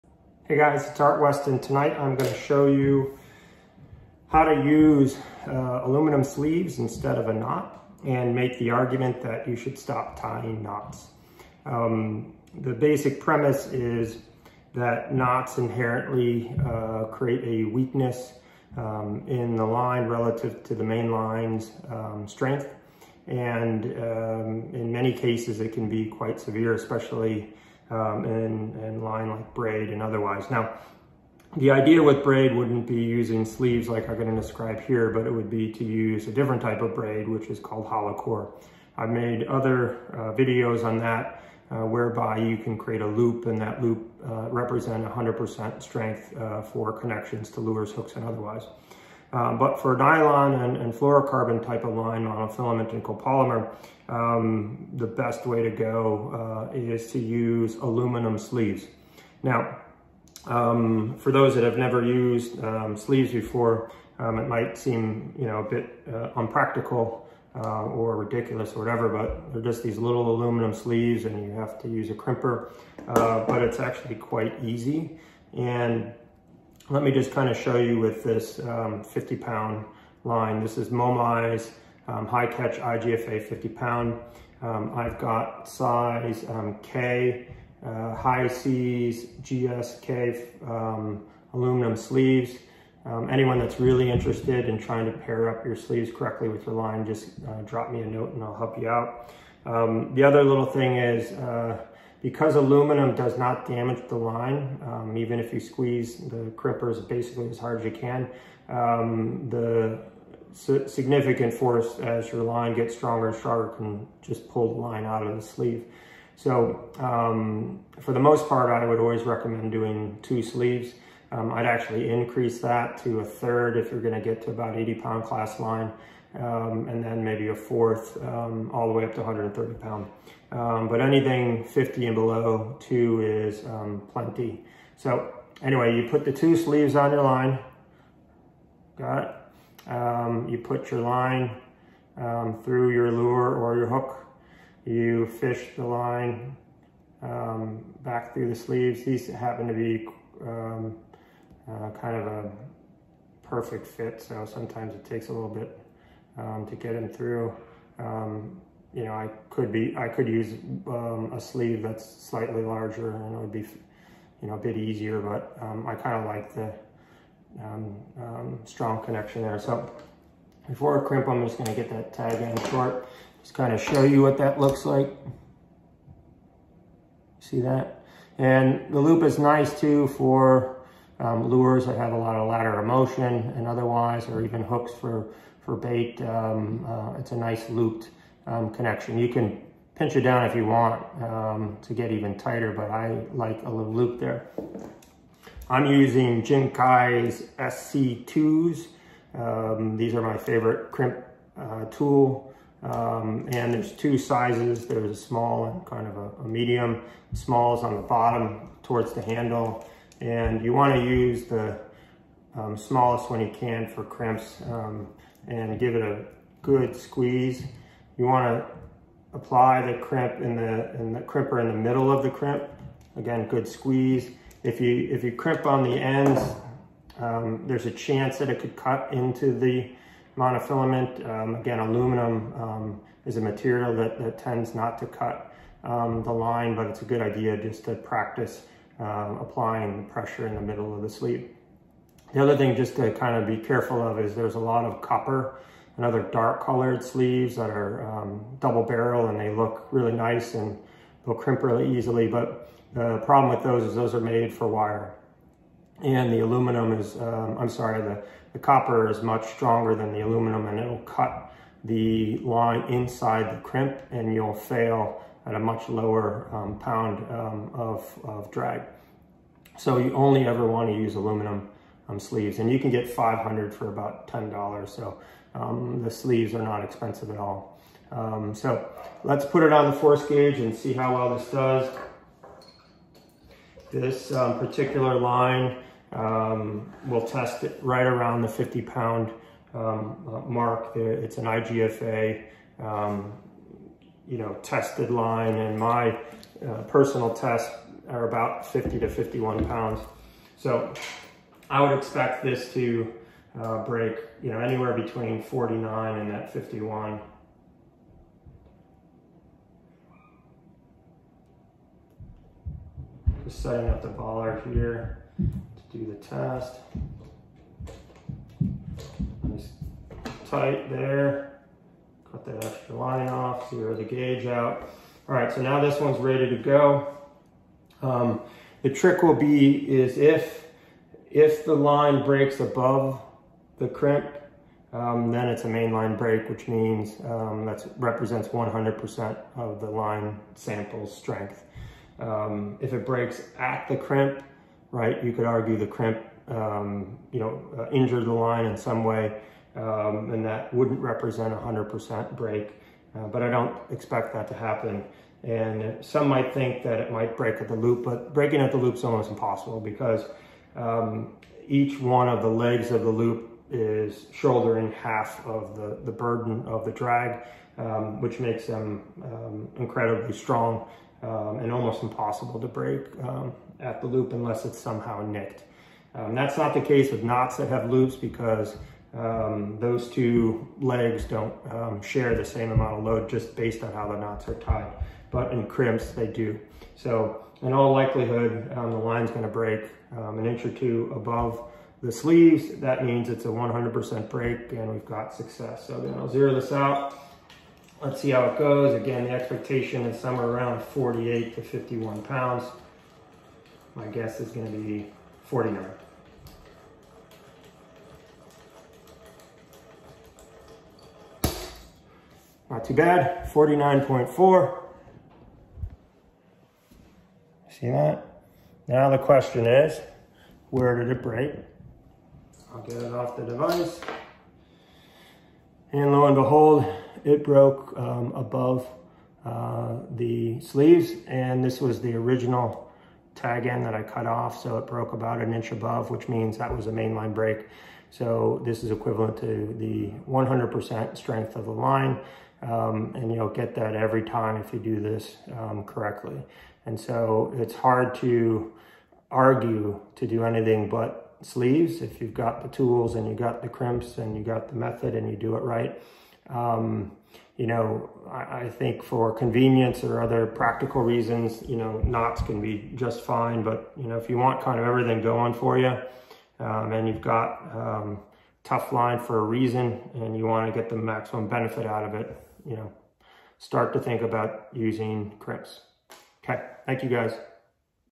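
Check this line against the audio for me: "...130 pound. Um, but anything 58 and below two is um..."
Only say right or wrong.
wrong.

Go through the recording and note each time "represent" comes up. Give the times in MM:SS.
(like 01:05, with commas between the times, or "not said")
00:44, 05:37, 05:50.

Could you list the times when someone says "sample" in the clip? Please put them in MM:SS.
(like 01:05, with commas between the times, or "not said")
05:40.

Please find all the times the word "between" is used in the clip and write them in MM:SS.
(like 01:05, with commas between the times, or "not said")
05:04.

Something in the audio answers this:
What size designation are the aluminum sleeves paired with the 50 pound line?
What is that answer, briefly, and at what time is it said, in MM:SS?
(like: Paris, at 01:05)
K, at 01:25.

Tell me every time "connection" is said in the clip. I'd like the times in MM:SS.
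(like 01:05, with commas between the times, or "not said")
00:46, 02:49, 03:08.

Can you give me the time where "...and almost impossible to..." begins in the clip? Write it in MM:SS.
06:11.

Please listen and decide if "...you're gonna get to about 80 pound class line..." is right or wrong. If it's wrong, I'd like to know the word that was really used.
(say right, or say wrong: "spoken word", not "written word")
right.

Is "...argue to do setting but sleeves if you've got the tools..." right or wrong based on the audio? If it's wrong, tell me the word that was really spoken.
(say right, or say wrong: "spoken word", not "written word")
wrong: "anything", not "setting".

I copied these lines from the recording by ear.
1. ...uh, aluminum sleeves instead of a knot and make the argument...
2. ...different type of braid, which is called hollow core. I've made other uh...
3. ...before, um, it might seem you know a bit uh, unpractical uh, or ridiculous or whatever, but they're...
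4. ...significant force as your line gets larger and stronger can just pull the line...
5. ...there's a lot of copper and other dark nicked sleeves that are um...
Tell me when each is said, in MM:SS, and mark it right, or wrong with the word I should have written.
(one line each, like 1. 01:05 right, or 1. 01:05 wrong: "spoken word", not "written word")
1. 00:05 right
2. 00:36 right
3. 01:03 right
4. 01:50 wrong: "stronger", not "larger"
5. 04:04 wrong: "colored", not "nicked".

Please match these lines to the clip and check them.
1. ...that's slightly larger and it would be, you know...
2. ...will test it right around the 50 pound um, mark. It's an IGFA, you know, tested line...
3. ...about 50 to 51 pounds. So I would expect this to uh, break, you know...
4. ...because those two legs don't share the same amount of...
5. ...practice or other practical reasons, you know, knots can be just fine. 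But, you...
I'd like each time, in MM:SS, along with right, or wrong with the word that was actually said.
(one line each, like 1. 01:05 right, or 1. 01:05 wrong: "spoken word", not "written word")
1. 02:41 right
2. 04:47 right
3. 04:58 right
4. 06:18 right
5. 07:39 wrong: "convenience", not "practice".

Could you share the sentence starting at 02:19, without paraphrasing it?
Um, you put your line um, through your lure or your hook, you fish the line back through the sleeves.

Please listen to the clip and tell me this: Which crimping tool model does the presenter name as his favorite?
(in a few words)
SC2.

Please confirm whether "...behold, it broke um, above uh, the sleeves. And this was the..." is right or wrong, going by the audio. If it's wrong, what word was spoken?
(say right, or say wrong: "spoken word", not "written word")
right.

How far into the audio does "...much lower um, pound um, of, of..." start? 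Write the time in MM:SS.
04:25.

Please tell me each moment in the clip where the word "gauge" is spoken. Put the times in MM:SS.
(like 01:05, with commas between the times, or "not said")
04:40, 05:24.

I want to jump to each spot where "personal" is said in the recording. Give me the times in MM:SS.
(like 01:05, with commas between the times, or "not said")
04:56.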